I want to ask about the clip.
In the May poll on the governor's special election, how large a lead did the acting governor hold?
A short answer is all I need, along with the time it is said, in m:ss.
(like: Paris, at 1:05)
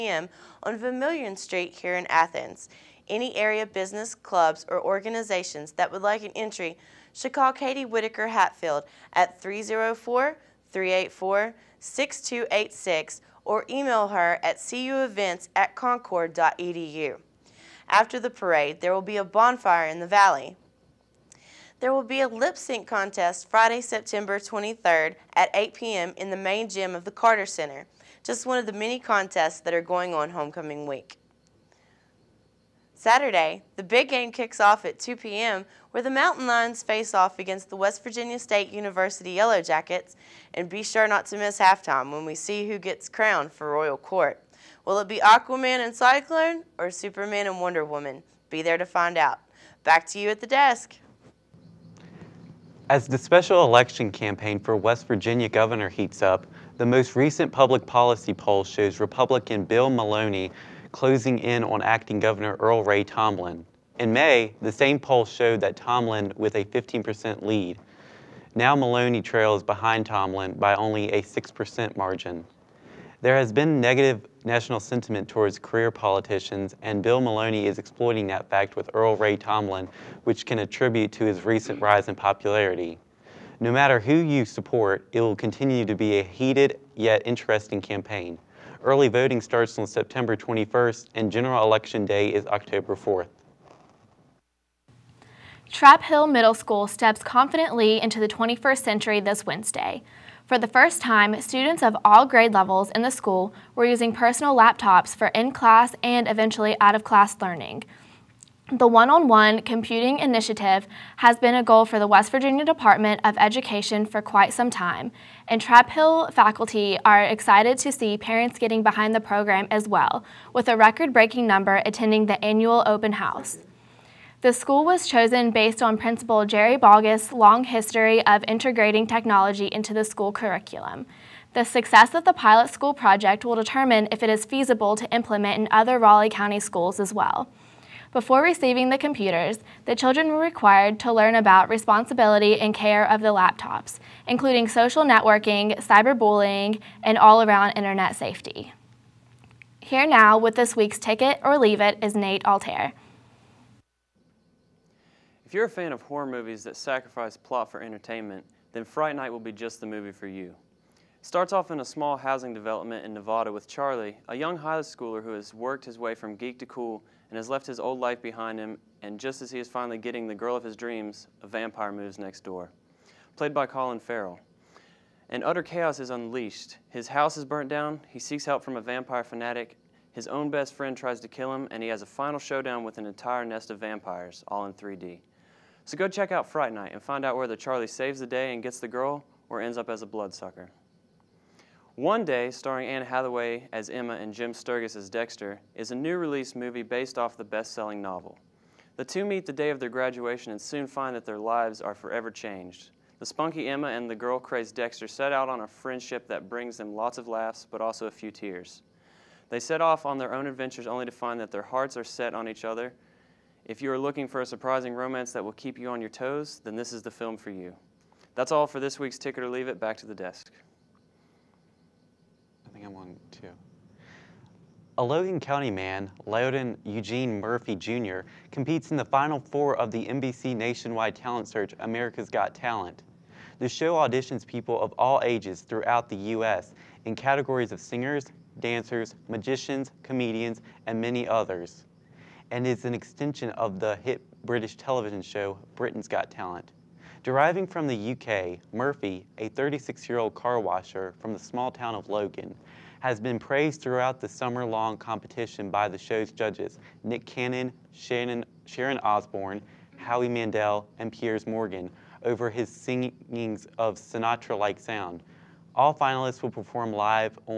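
15%, at 1:06.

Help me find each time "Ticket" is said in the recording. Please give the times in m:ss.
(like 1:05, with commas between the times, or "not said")
2:30, 3:39.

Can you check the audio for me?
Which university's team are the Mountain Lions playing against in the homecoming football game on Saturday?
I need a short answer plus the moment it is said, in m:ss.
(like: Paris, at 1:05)
West Virginia State University, at 0:37.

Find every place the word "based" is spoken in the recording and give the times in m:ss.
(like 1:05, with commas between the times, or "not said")
2:05, 3:16.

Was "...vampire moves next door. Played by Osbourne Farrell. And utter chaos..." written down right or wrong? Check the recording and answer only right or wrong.
wrong.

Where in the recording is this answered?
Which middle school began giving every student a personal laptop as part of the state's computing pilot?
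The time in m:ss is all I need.
1:35.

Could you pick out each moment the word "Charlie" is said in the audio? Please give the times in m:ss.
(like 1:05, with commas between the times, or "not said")
2:43, 3:07.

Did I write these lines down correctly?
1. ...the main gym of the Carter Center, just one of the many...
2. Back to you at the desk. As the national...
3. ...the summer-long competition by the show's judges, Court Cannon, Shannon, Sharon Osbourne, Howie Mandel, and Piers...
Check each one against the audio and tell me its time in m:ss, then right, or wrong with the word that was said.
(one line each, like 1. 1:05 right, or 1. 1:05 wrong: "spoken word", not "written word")
1. 0:26 right
2. 0:49 wrong: "special", not "national"
3. 4:14 wrong: "Nick", not "Court".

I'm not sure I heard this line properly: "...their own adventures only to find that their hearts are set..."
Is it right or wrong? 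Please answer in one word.
right.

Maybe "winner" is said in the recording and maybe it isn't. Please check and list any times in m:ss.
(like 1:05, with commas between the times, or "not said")
not said.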